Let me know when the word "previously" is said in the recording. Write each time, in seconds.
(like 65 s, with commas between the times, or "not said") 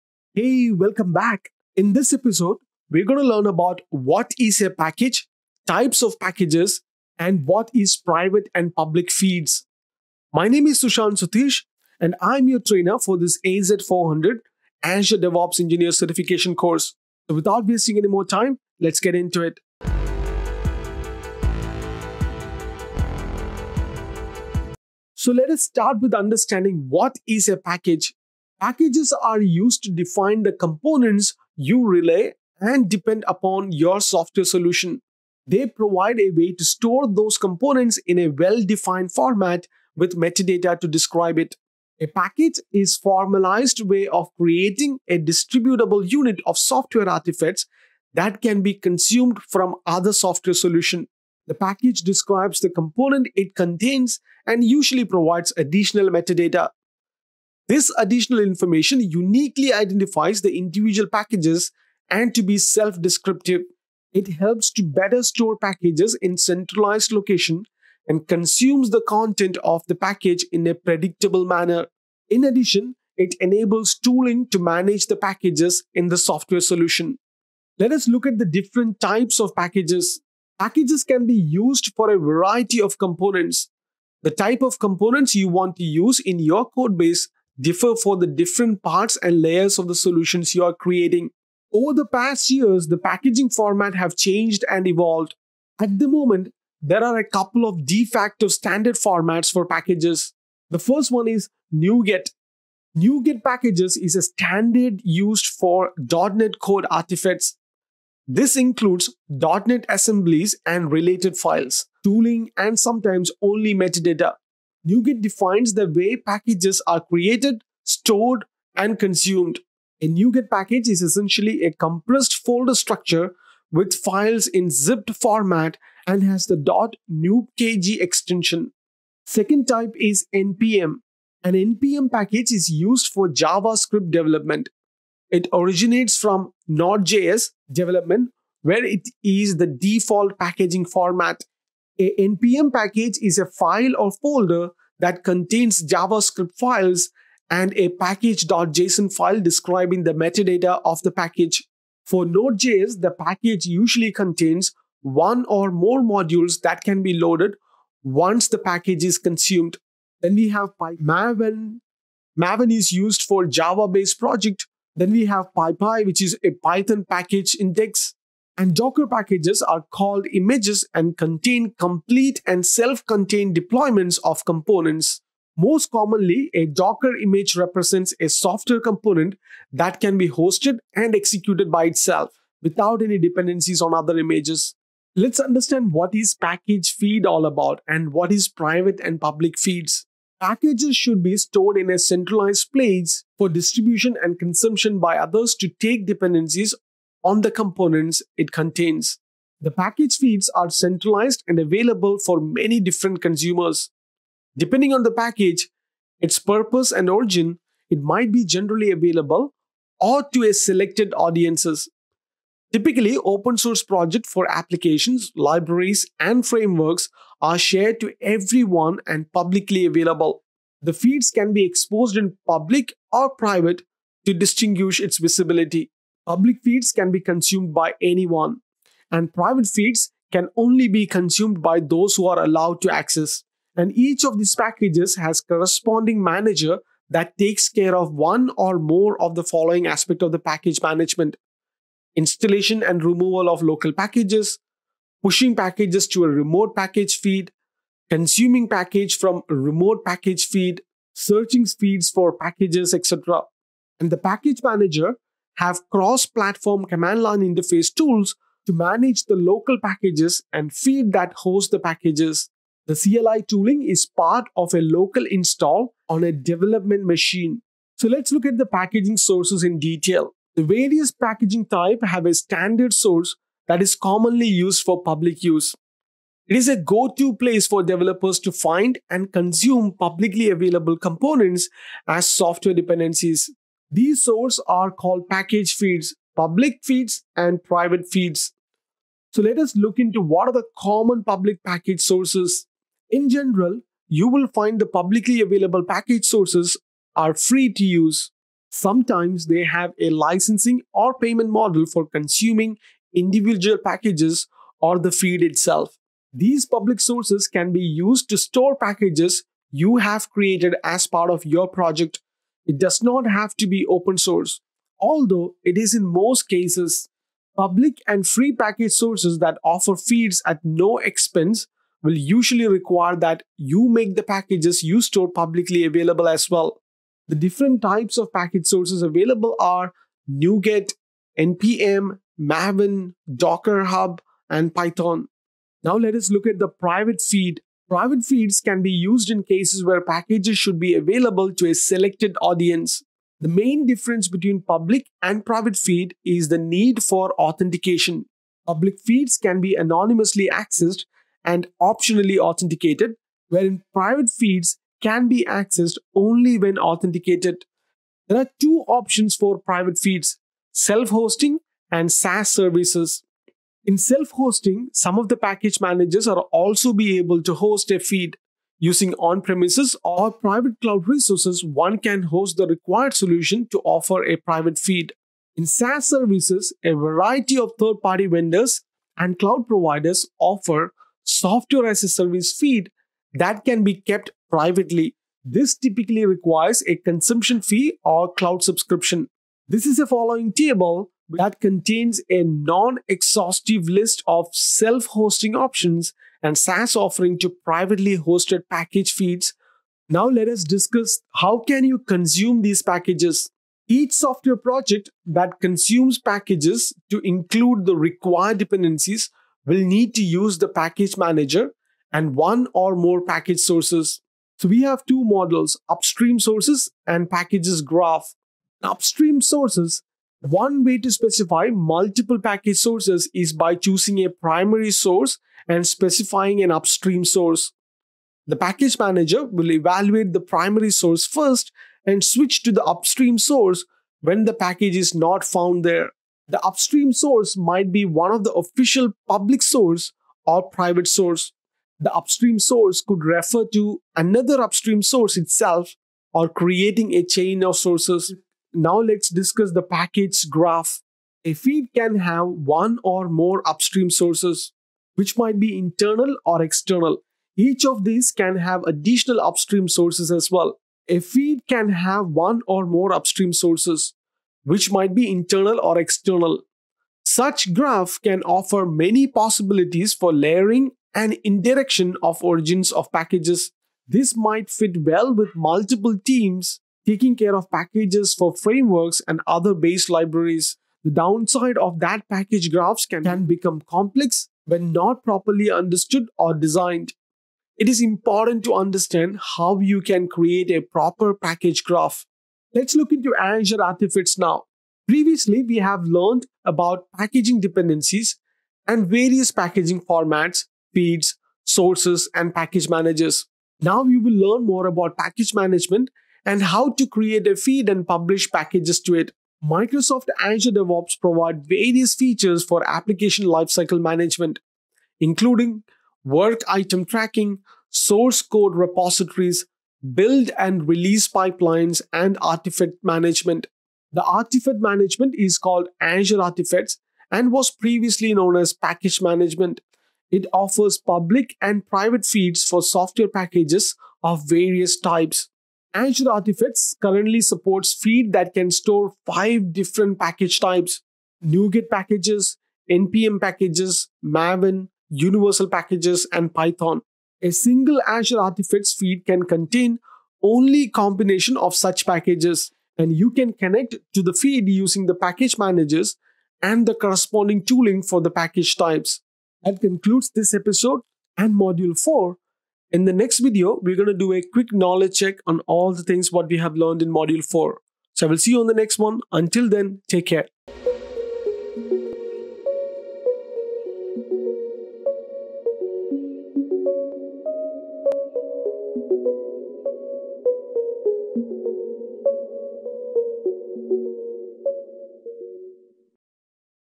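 495 s, 527 s.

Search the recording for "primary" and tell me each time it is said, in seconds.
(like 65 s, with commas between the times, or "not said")
424 s, 430 s.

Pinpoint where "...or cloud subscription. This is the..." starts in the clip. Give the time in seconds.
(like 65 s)
388 s.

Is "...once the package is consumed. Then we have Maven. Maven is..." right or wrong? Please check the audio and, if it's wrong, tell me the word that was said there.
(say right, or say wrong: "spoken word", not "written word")
right.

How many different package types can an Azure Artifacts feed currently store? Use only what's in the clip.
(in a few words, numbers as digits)
5.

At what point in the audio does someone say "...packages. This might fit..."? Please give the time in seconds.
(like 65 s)
473 s.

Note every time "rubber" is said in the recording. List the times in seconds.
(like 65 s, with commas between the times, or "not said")
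not said.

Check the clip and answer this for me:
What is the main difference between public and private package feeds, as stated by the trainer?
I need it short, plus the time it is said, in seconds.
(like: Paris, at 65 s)
Authentication, at 346 s.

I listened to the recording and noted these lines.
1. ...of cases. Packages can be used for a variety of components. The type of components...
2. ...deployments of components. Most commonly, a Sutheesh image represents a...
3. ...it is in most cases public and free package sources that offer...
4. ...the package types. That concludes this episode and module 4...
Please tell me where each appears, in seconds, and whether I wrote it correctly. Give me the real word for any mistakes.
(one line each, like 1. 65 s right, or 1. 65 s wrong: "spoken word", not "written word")
1. 79 s wrong: "packages", not "cases"
2. 173 s wrong: "Docker", not "Sutheesh"
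3. 315 s right
4. 558 s right.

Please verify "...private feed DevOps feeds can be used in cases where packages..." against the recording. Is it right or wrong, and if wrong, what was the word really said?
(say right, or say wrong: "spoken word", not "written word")
wrong: "Private", not "DevOps".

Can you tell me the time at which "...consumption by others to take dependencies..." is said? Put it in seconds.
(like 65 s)
194 s.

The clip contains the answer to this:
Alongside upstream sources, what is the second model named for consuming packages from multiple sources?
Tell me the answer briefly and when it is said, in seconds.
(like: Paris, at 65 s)
Packages graph, at 417 s.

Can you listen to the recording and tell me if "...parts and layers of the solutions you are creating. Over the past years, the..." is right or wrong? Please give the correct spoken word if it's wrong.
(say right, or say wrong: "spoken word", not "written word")
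right.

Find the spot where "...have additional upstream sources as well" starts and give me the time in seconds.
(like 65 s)
458 s.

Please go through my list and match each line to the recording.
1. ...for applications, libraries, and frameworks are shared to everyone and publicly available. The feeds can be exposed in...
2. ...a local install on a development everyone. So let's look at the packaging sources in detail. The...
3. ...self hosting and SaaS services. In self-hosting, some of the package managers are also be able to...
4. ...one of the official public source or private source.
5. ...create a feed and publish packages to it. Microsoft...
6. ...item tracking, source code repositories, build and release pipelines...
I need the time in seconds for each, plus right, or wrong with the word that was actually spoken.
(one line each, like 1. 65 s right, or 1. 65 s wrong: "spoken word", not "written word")
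1. 214 s right
2. 264 s wrong: "machine", not "everyone"
3. 360 s right
4. 438 s right
5. 507 s right
6. 516 s right.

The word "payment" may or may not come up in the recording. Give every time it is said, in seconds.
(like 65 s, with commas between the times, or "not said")
301 s.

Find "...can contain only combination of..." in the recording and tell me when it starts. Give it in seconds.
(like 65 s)
549 s.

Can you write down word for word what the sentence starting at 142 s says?
A NPM package is a file or folder that contains JavaScript files and a package.json file describing the metadata of the package.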